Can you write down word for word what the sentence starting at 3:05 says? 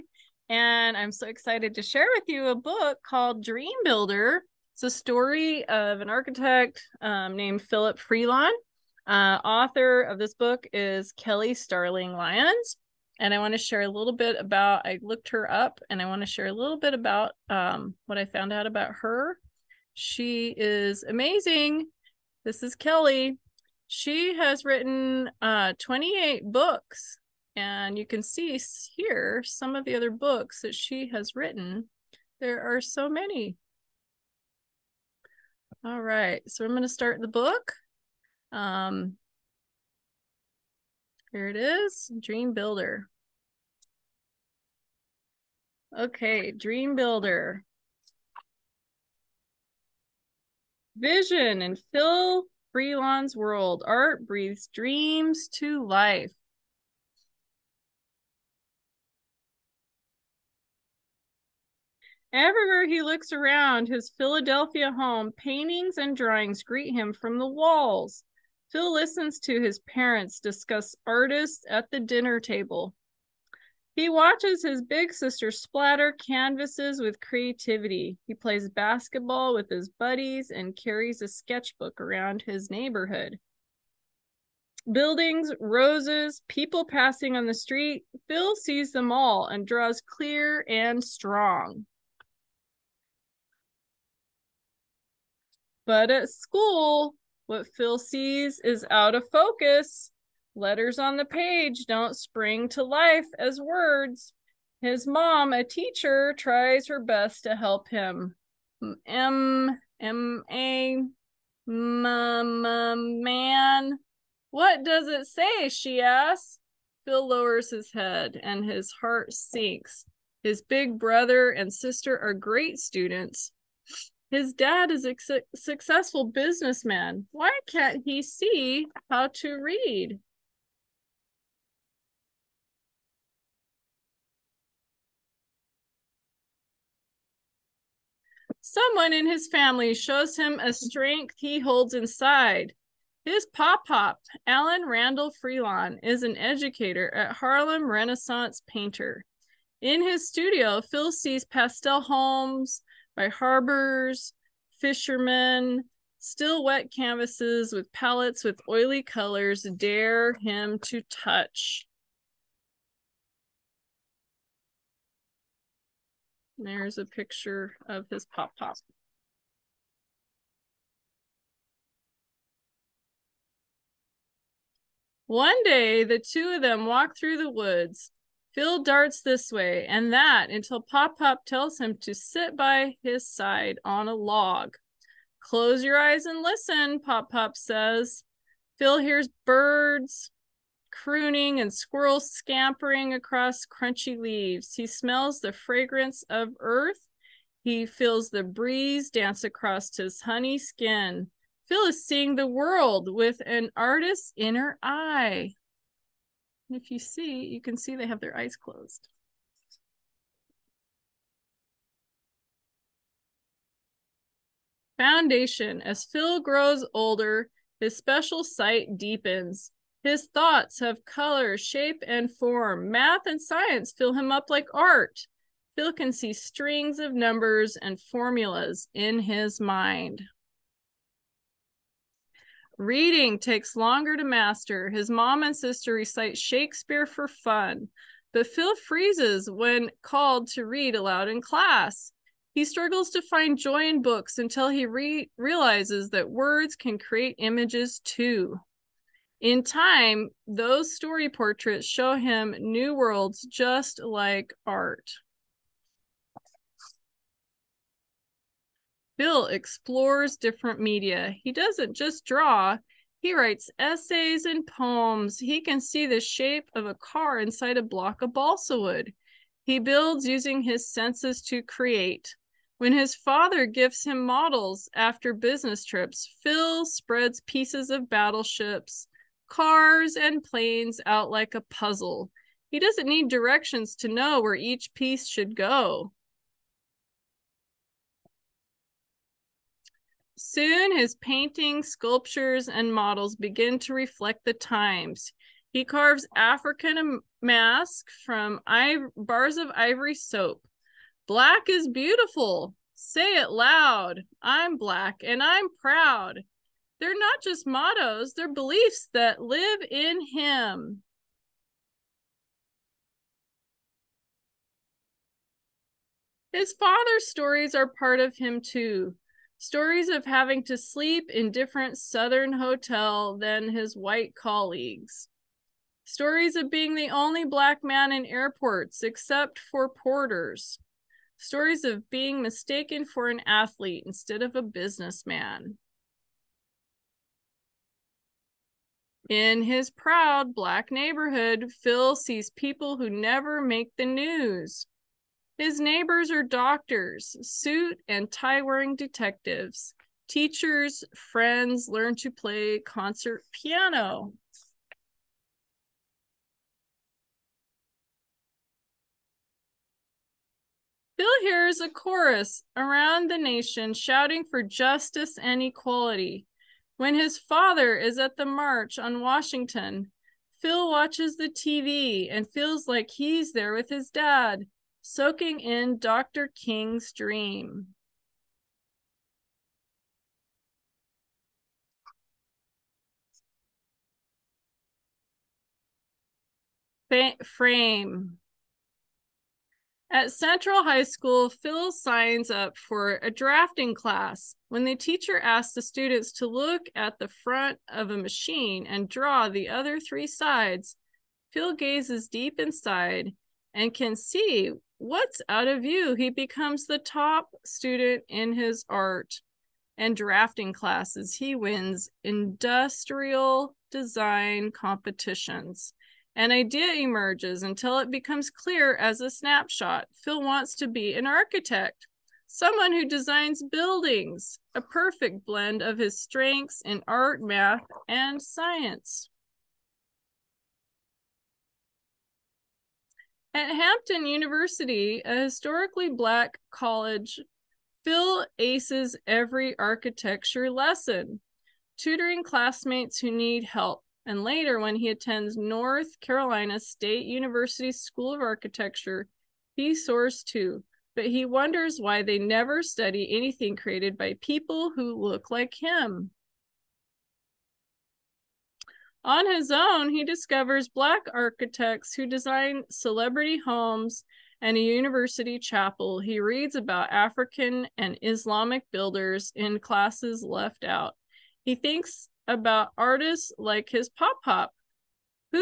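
Close your eyes and listen, Pop Pop says.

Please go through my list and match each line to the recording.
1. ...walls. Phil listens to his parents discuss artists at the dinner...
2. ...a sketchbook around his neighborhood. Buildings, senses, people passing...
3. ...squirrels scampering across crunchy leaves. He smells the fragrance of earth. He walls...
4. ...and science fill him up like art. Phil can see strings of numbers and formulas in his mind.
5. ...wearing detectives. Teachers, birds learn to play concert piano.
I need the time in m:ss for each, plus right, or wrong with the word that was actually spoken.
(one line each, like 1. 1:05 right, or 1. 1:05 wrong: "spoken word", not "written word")
1. 1:07 right
2. 1:21 wrong: "roses", not "senses"
3. 3:11 wrong: "feels", not "walls"
4. 3:43 right
5. 5:48 wrong: "friends", not "birds".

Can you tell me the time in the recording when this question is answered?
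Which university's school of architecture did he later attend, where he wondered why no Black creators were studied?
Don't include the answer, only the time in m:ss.
7:25.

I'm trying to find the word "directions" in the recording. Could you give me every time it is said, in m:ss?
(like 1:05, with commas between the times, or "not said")
4:43.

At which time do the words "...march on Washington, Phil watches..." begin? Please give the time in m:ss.
6:08.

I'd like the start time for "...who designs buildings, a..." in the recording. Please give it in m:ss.
7:02.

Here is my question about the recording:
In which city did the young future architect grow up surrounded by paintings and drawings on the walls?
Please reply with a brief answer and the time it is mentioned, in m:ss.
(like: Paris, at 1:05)
Philadelphia, at 1:04.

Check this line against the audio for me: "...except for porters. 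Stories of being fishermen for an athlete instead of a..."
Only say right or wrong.
wrong.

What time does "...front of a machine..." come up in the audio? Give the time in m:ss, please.
6:37.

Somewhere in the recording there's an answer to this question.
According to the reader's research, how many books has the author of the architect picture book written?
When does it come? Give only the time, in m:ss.
0:25.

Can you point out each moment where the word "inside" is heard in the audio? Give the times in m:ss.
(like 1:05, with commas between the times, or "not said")
2:21, 4:27, 6:42.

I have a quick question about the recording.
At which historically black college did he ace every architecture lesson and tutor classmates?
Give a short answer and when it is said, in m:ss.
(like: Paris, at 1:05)
Hampton University, at 7:13.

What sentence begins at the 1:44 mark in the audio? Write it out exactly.
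His mom, a teacher, tries her best to help him.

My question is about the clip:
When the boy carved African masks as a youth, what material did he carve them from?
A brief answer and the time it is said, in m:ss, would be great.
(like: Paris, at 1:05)
Ivory soap, at 4:59.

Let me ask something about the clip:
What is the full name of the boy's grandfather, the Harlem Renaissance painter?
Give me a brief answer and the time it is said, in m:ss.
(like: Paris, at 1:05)
Allan Randall Freelon, at 2:24.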